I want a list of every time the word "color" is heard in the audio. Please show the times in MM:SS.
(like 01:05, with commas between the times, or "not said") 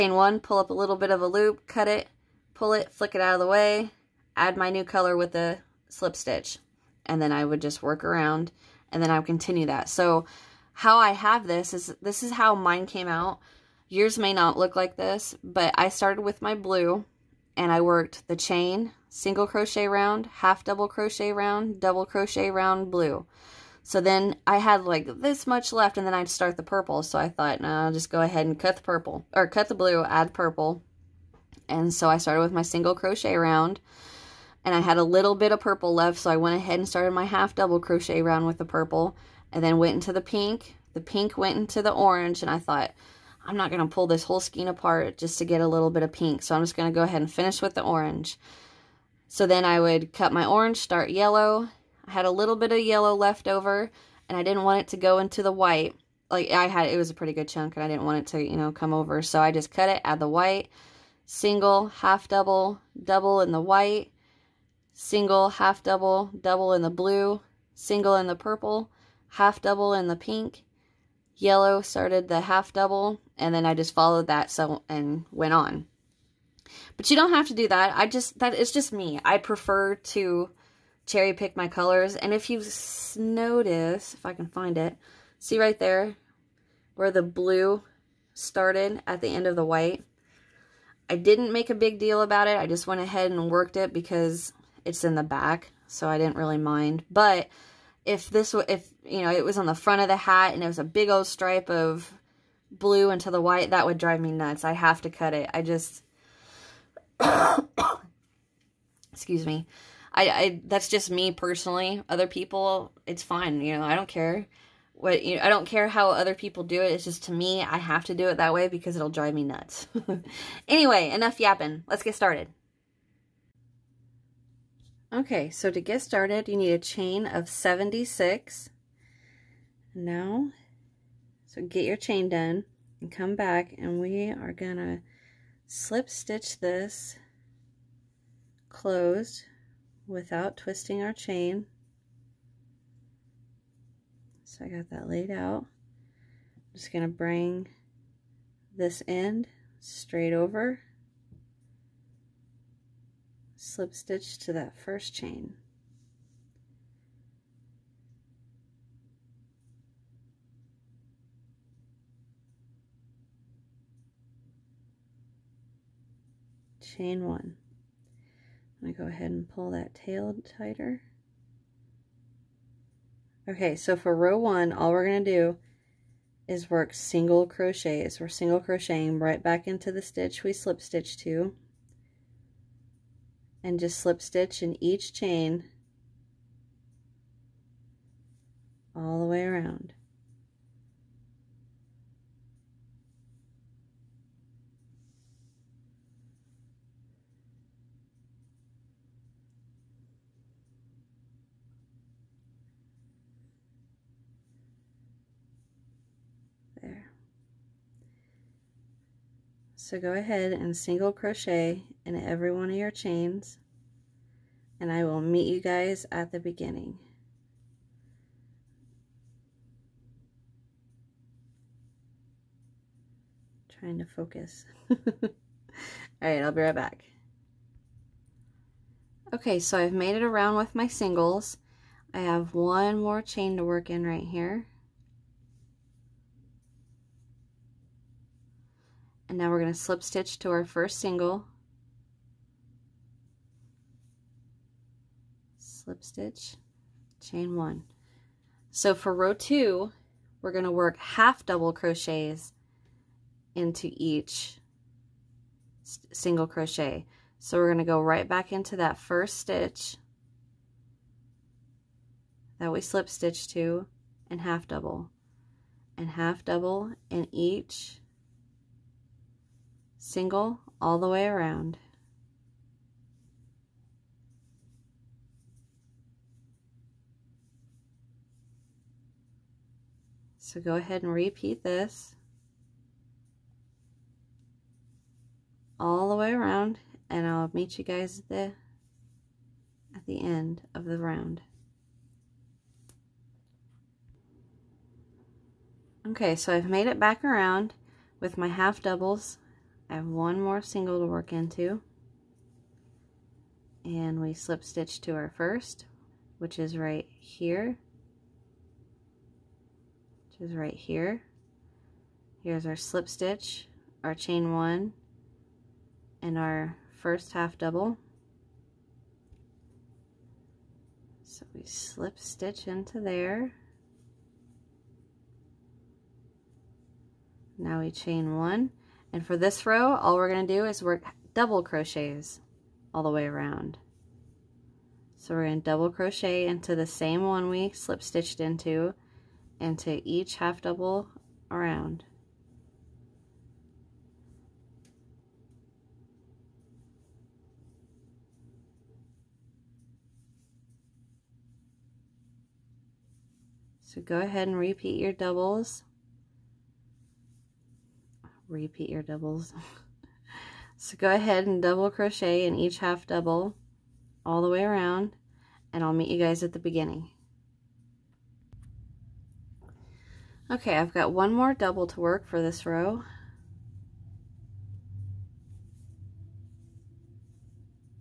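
00:04, 01:21.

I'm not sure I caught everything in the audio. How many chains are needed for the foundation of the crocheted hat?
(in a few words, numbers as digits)
76.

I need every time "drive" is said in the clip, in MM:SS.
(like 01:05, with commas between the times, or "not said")
01:43, 01:59.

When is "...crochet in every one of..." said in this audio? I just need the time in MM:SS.
03:31.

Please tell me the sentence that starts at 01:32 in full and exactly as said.
I just went ahead and worked it because it's in the back, so I didn't really mind.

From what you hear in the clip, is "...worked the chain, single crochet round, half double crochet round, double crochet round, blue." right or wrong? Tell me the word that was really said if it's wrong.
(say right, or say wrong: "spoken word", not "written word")
right.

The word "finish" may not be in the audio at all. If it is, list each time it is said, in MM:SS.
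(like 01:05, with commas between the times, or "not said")
00:47.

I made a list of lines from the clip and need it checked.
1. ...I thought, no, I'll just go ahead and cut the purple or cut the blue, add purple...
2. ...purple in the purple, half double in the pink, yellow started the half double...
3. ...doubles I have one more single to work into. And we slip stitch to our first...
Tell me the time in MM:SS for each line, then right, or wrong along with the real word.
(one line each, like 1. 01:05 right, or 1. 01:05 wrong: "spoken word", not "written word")
1. 00:27 right
2. 01:07 wrong: "single", not "purple"
3. 04:58 right.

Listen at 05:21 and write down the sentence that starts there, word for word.
So we slip stitch into there.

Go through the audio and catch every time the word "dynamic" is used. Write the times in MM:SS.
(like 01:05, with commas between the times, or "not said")
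not said.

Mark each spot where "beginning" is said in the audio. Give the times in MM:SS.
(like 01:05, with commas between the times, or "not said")
03:36, 06:06.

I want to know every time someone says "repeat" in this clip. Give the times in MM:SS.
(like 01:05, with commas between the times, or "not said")
04:41, 05:54, 05:58.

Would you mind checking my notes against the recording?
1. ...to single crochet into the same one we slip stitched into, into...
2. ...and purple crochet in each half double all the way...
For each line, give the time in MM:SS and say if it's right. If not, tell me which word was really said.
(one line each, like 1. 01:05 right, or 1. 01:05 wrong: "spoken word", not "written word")
1. 05:35 wrong: "double", not "single"
2. 06:01 wrong: "double", not "purple".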